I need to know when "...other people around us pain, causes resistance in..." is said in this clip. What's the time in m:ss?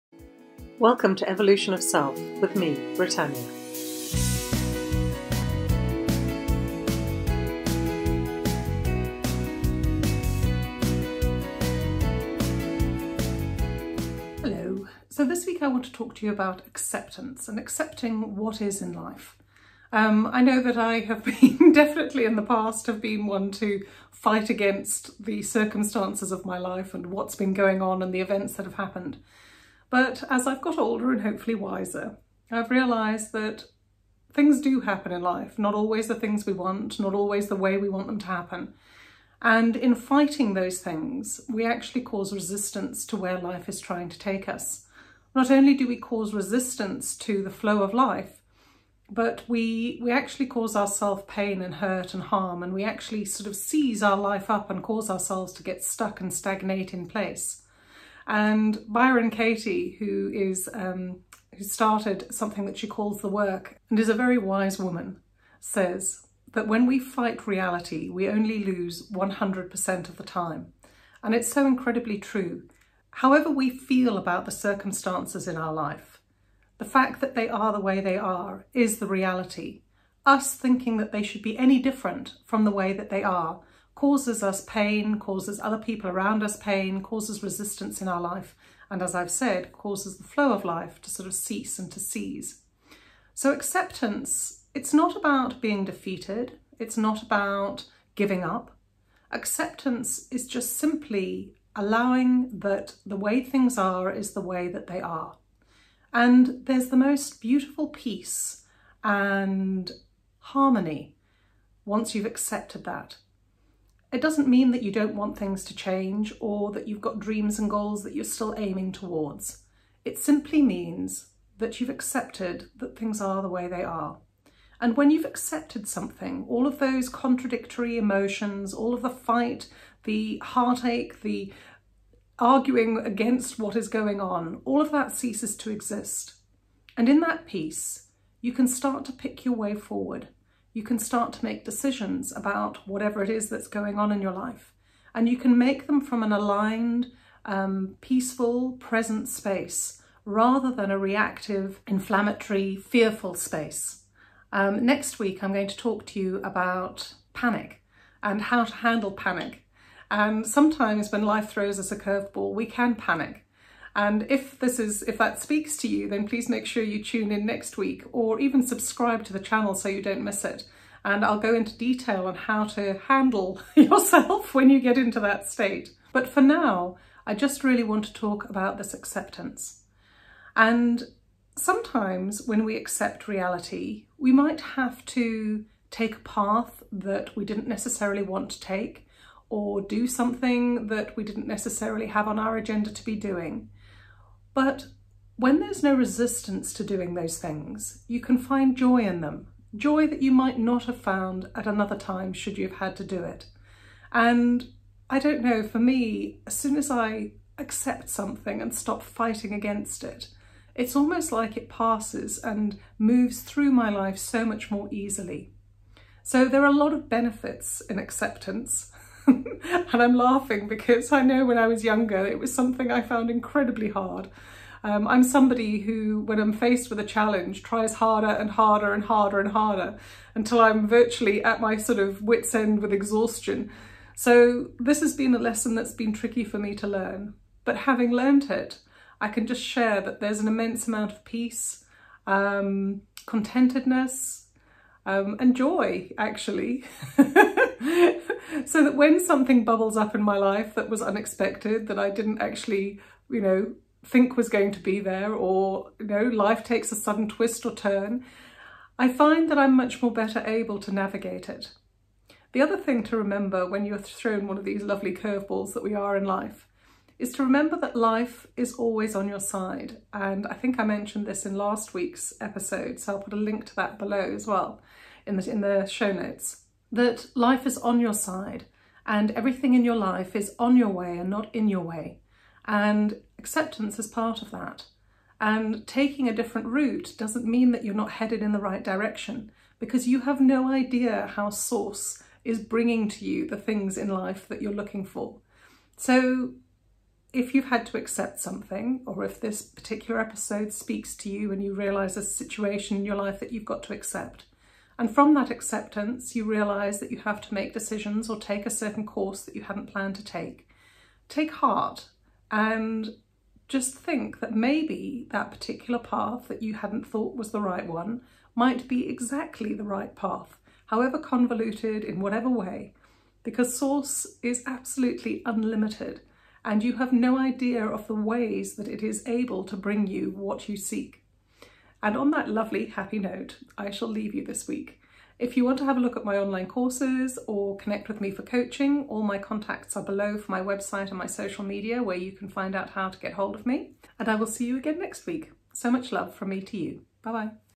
1:25.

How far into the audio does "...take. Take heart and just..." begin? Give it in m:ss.
5:10.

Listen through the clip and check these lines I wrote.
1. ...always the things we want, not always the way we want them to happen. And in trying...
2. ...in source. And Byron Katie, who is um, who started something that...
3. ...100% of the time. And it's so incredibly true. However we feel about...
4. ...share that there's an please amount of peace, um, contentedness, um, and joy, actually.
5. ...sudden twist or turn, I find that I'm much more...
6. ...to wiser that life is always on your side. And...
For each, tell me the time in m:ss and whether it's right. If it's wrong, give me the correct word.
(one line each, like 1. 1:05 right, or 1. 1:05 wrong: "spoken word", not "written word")
1. 0:35 wrong: "fighting", not "trying"
2. 0:56 wrong: "place", not "source"
3. 1:09 right
4. 3:59 wrong: "immense", not "please"
5. 4:16 right
6. 4:27 wrong: "remember", not "wiser".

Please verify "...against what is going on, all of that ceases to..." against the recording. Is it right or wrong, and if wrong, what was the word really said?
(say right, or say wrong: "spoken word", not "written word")
right.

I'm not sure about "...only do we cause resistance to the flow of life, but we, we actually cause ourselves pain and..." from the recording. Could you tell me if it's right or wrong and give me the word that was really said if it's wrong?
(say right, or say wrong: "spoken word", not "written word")
right.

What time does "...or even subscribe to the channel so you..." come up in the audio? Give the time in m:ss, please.
2:48.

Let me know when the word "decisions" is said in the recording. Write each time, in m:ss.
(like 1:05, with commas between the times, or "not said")
2:21, 5:07.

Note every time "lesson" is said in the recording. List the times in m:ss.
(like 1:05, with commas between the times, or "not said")
3:55.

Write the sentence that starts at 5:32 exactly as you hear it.
And on that lovely happy note, I shall leave you this week.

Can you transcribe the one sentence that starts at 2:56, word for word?
But for now, I just really want to talk about this acceptance.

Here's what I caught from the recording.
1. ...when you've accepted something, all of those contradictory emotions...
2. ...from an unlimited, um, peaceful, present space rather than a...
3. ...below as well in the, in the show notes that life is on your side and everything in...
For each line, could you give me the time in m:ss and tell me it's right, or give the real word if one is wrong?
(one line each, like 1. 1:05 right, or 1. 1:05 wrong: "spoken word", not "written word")
1. 2:04 right
2. 2:26 wrong: "aligned", not "unlimited"
3. 4:33 right.